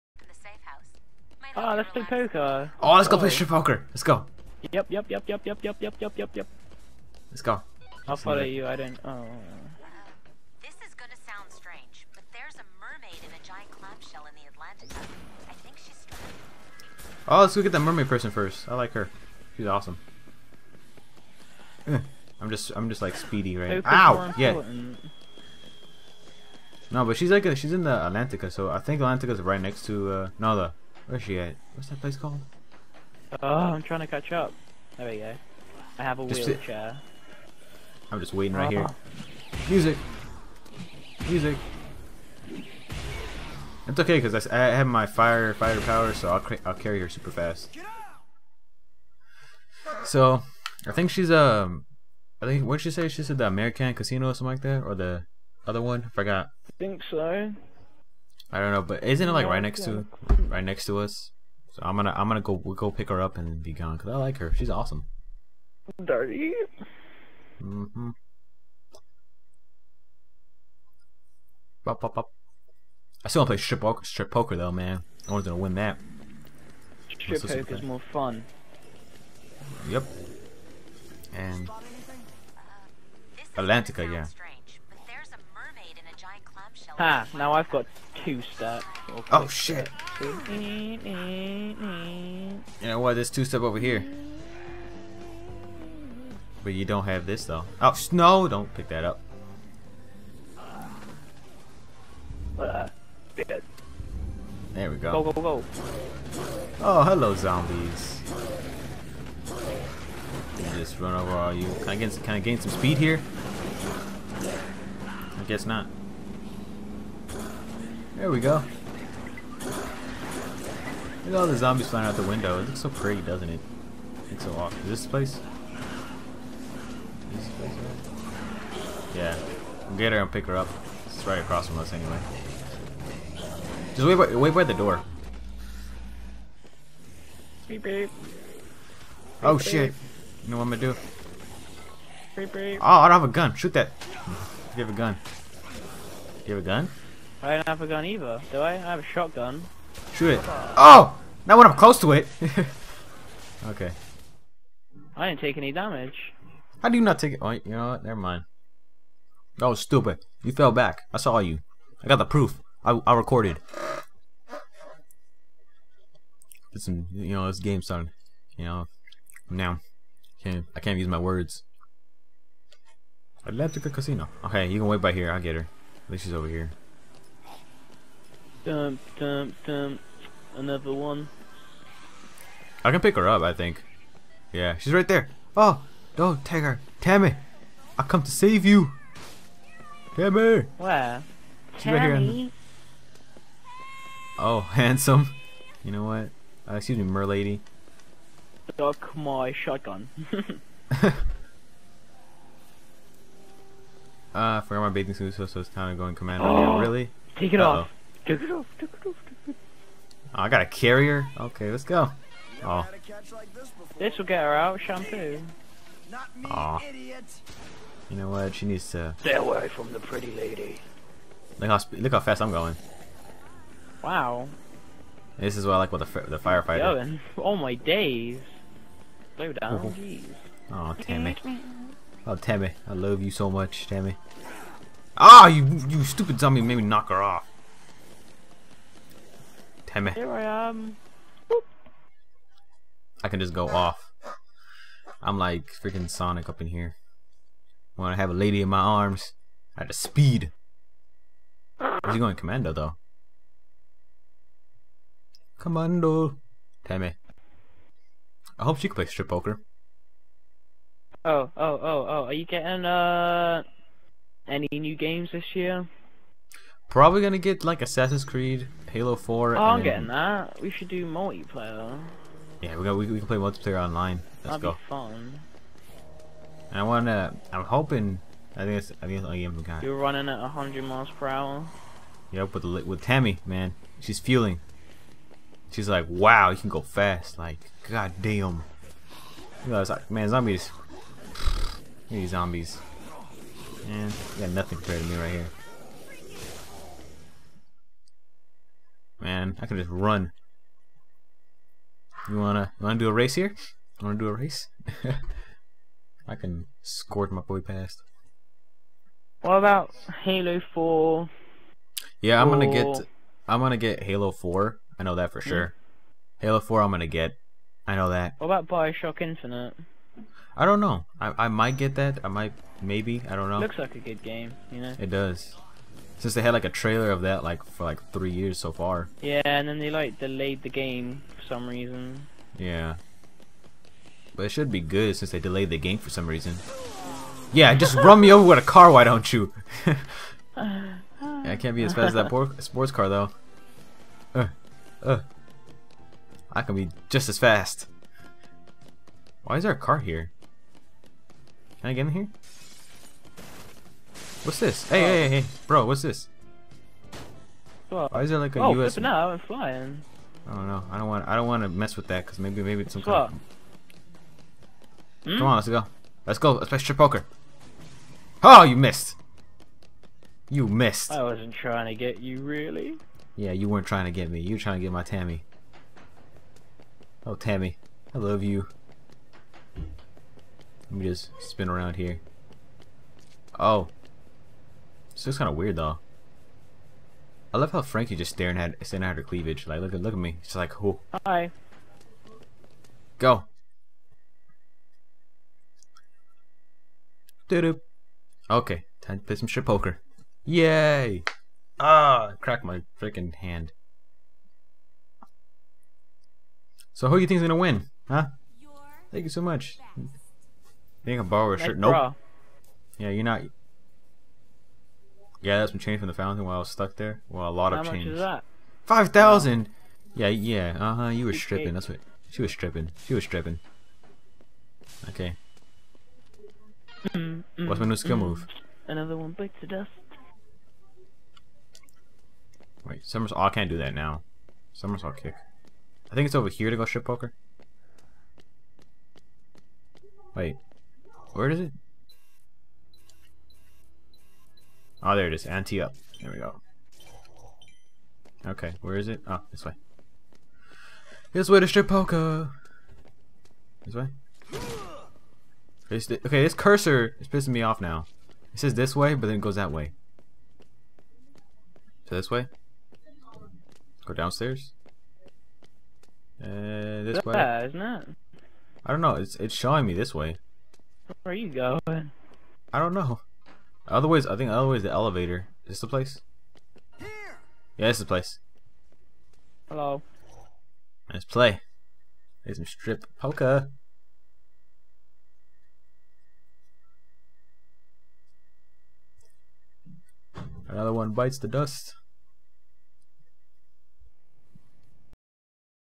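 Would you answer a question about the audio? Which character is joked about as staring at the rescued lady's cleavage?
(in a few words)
Frankie.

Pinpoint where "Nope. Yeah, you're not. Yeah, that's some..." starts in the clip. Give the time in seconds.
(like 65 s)
411 s.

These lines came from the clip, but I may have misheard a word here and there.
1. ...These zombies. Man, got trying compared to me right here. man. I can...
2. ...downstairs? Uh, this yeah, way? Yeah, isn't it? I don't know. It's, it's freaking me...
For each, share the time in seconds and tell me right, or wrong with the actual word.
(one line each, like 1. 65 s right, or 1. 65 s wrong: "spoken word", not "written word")
1. 292 s wrong: "nothing", not "trying"
2. 464 s wrong: "showing", not "freaking".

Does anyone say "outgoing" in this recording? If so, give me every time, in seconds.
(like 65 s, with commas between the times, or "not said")
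not said.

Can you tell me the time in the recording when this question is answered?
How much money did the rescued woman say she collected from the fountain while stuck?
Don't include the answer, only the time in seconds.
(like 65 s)
418 s.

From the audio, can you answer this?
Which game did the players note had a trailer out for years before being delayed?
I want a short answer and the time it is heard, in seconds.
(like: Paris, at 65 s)
Bioshock Infinite, at 318 s.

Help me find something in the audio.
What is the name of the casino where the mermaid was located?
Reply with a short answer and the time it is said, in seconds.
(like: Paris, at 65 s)
Atlantica Casino, at 173 s.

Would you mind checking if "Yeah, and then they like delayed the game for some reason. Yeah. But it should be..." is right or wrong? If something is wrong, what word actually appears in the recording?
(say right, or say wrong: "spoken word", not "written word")
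right.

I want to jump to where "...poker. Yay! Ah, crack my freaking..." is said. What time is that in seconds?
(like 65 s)
399 s.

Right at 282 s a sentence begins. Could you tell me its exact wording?
Yep, with the, with Tammy, man, she's fueling.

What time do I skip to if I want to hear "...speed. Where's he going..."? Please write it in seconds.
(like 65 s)
249 s.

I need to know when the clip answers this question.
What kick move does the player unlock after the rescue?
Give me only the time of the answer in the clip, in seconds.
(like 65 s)
434 s.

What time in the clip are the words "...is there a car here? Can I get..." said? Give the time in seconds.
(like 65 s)
349 s.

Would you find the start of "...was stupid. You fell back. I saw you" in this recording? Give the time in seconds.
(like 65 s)
159 s.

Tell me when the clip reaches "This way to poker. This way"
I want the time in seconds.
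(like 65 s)
451 s.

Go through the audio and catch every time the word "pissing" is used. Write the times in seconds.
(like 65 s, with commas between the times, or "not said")
457 s.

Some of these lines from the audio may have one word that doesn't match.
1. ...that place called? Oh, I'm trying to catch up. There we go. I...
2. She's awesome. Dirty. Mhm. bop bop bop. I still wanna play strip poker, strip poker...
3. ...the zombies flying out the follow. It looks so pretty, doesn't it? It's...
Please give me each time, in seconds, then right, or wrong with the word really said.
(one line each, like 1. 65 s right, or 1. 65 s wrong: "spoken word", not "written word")
1. 31 s right
2. 64 s right
3. 121 s wrong: "window", not "follow".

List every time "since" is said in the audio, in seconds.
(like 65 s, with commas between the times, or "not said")
326 s, 335 s.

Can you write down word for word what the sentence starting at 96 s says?
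But you don't have this though.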